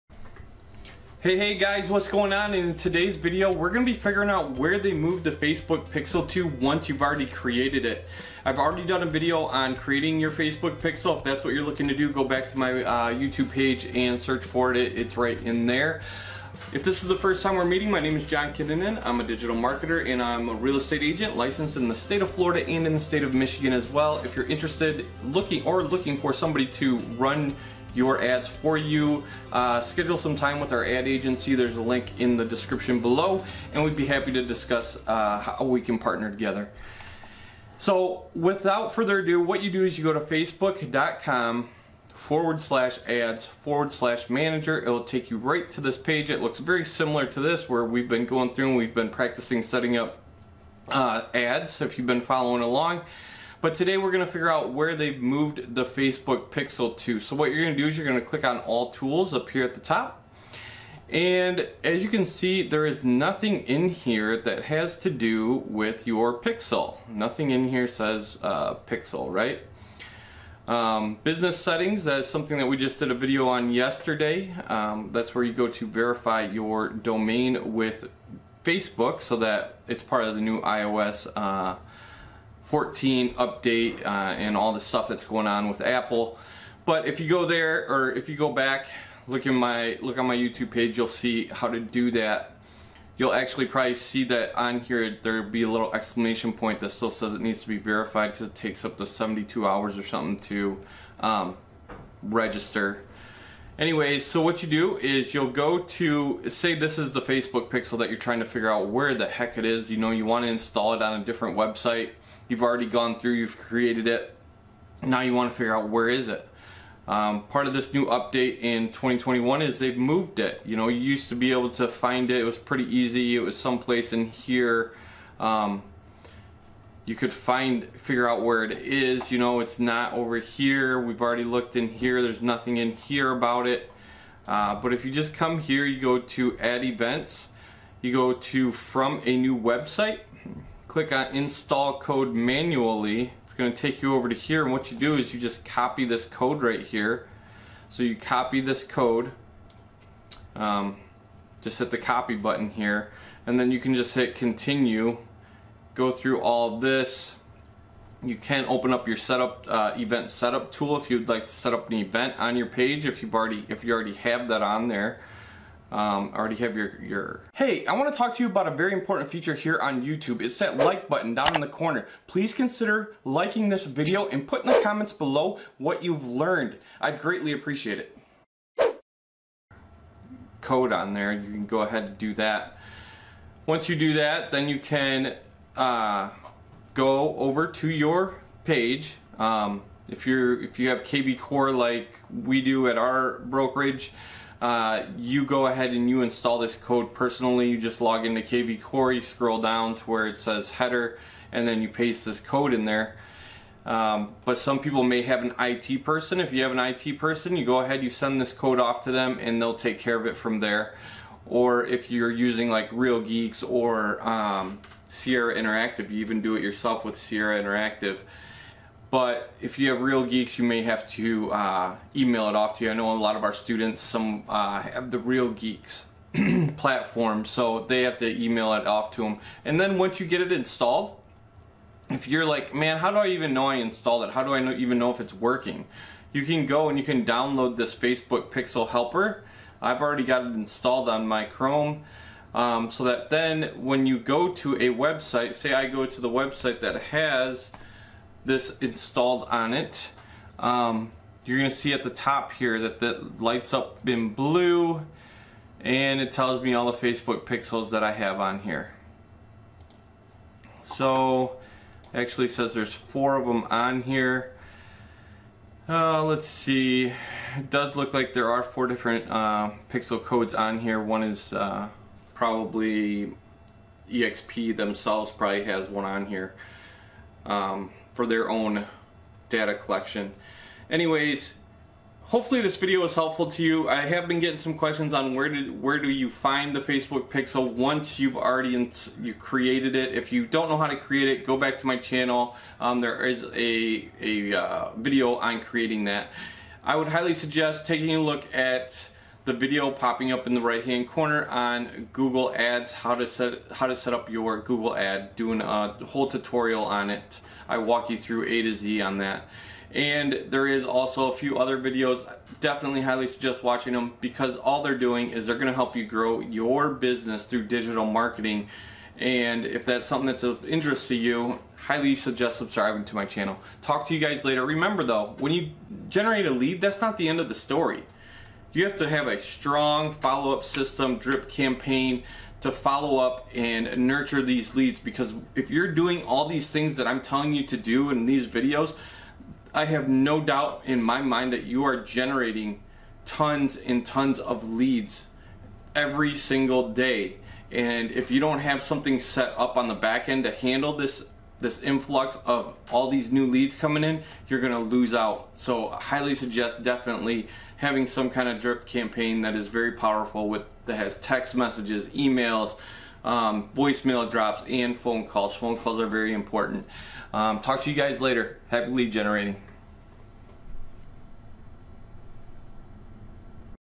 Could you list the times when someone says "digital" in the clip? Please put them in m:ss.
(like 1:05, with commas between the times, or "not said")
0:19, 5:17.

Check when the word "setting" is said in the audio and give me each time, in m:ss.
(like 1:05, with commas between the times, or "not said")
0:49, 1:11.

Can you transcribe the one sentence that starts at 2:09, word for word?
You know, it's not over here.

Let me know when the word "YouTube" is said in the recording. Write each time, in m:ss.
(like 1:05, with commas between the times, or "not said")
0:13, 1:30, 2:50.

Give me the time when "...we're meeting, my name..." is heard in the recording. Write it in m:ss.
0:17.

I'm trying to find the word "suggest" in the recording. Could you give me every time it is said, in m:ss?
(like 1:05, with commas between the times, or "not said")
4:57, 5:13, 5:22, 5:56.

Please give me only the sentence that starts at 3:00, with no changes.
Code on there, you can go ahead and do that.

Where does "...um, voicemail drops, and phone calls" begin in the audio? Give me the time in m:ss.
6:03.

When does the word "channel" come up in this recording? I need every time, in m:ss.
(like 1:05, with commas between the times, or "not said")
4:51, 5:23.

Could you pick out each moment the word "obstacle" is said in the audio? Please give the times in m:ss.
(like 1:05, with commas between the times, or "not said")
not said.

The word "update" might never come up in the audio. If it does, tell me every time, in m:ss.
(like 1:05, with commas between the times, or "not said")
1:23, 1:58.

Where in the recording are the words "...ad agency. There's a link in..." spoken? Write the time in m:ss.
0:30.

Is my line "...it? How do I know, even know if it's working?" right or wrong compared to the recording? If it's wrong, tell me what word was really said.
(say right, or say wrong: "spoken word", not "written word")
right.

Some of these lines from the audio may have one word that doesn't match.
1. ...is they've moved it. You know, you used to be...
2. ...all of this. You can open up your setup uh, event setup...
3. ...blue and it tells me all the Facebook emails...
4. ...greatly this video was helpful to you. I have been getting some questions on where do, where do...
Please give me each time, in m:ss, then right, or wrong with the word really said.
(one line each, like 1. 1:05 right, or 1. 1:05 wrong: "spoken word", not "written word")
1. 1:59 right
2. 2:36 right
3. 4:14 wrong: "pixels", not "emails"
4. 4:42 wrong: "hopefully", not "greatly".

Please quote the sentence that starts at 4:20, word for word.
So actually says there's four of them on here.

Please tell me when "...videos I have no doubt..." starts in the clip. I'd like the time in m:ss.
5:38.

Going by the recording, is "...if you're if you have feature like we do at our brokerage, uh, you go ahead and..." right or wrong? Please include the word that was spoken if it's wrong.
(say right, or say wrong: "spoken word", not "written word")
wrong: "kvCORE", not "feature".